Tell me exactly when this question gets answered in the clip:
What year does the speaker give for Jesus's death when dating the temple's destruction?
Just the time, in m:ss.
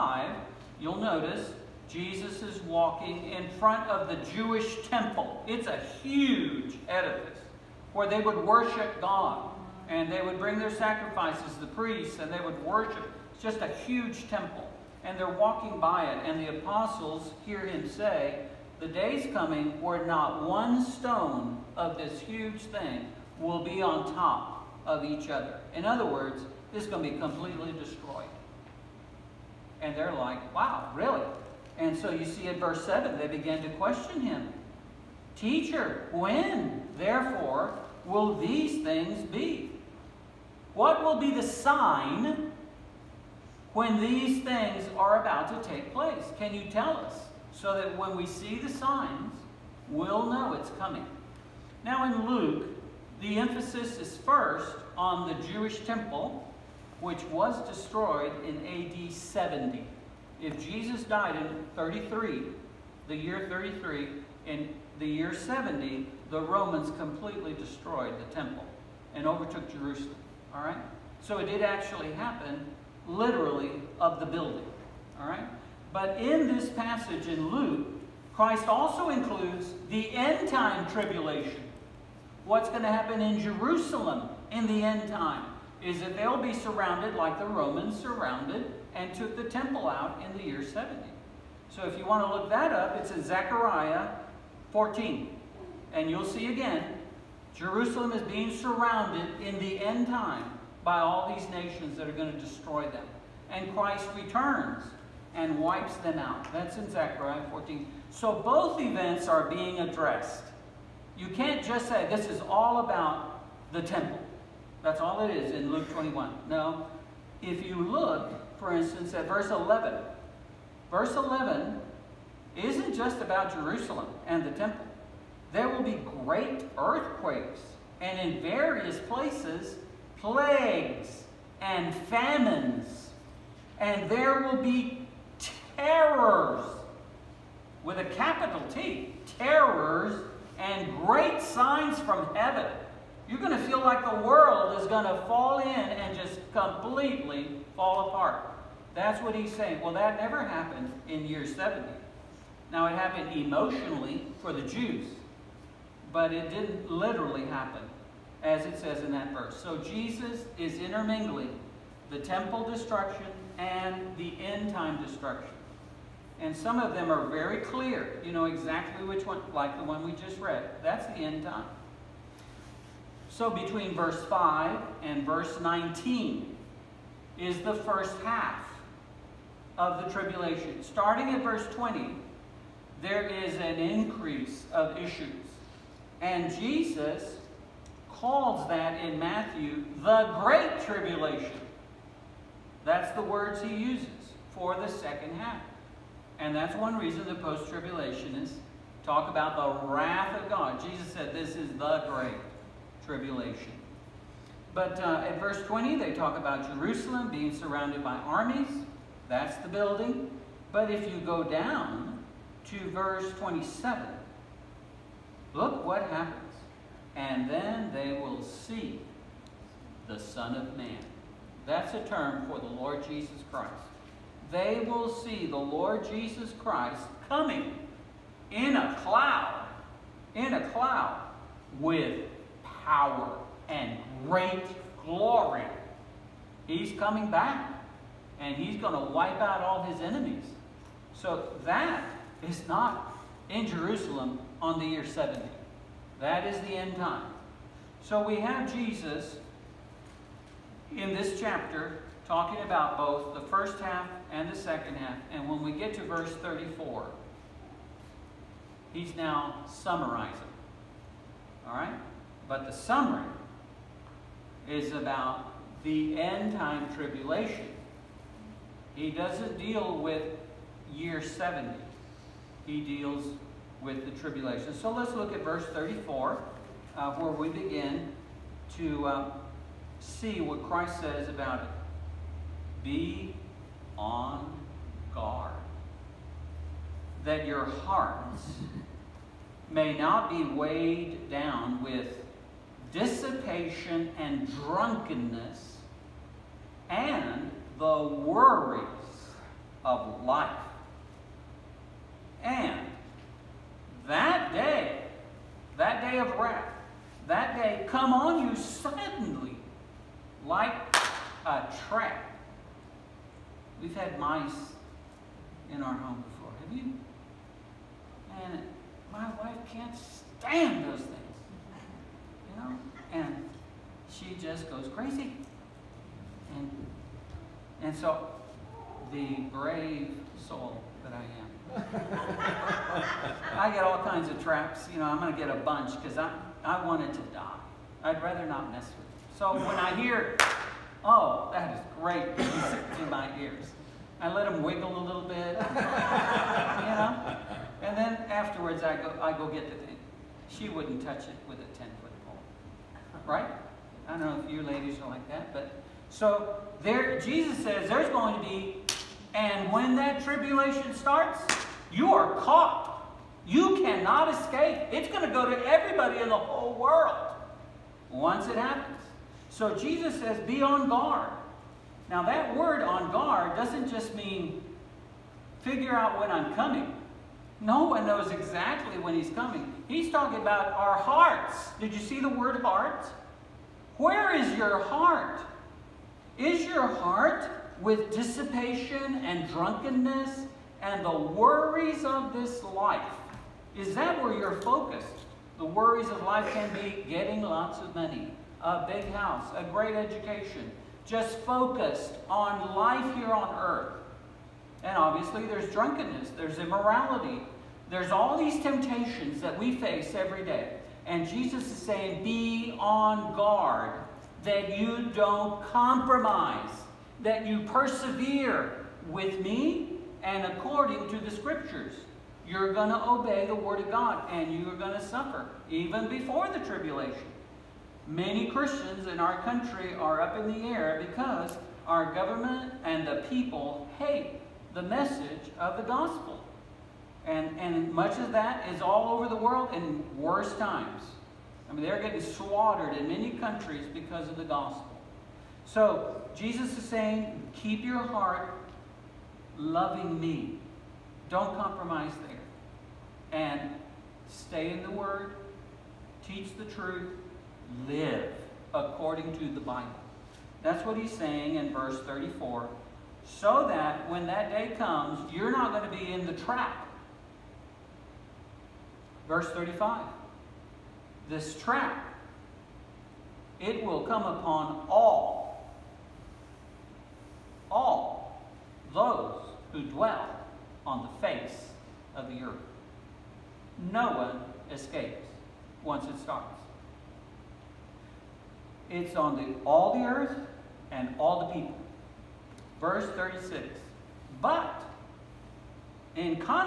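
1:03.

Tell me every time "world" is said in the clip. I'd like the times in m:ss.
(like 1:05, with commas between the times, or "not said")
2:24, 6:06, 7:19.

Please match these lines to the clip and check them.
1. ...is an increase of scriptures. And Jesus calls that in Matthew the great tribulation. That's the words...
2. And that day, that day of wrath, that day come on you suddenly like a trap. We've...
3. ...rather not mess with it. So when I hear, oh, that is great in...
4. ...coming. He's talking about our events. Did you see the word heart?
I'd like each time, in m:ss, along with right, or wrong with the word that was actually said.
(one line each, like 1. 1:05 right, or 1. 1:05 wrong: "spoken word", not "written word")
1. 3:03 wrong: "issues", not "scriptures"
2. 5:02 right
3. 5:38 right
4. 6:19 wrong: "hearts", not "events".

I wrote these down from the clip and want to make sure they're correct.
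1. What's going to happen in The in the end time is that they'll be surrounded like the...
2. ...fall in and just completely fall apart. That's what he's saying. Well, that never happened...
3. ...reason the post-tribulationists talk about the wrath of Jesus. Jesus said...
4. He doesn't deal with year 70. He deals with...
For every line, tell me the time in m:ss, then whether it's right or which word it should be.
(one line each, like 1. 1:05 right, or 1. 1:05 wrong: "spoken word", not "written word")
1. 1:22 wrong: "Jerusalem", not "The"
2. 2:25 right
3. 3:16 wrong: "God", not "Jesus"
4. 4:28 right.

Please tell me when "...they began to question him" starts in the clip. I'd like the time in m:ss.
0:33.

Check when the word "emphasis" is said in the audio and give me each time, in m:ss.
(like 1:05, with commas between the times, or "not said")
0:53.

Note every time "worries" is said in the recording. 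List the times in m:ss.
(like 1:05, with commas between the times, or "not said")
4:58, 6:31, 6:35.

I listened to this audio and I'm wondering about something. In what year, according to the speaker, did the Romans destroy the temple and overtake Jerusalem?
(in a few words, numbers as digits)
AD 70.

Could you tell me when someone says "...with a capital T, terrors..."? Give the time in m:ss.
2:17.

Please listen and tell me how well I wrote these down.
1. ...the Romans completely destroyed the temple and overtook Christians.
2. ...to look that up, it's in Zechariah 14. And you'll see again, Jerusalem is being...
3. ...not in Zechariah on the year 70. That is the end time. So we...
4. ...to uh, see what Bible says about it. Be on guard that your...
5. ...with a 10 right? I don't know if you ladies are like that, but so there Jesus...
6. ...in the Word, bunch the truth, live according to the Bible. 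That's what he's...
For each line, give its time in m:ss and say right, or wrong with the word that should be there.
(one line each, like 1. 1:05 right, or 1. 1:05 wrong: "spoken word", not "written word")
1. 1:06 wrong: "Jerusalem", not "Christians"
2. 1:32 right
3. 4:02 wrong: "Jerusalem", not "Zechariah"
4. 4:38 wrong: "Christ", not "Bible"
5. 5:51 right
6. 7:34 wrong: "teach", not "bunch".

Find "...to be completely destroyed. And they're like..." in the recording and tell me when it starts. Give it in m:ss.
0:27.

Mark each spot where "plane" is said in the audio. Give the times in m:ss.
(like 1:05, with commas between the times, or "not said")
not said.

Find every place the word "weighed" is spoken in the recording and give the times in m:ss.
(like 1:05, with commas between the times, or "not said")
4:50.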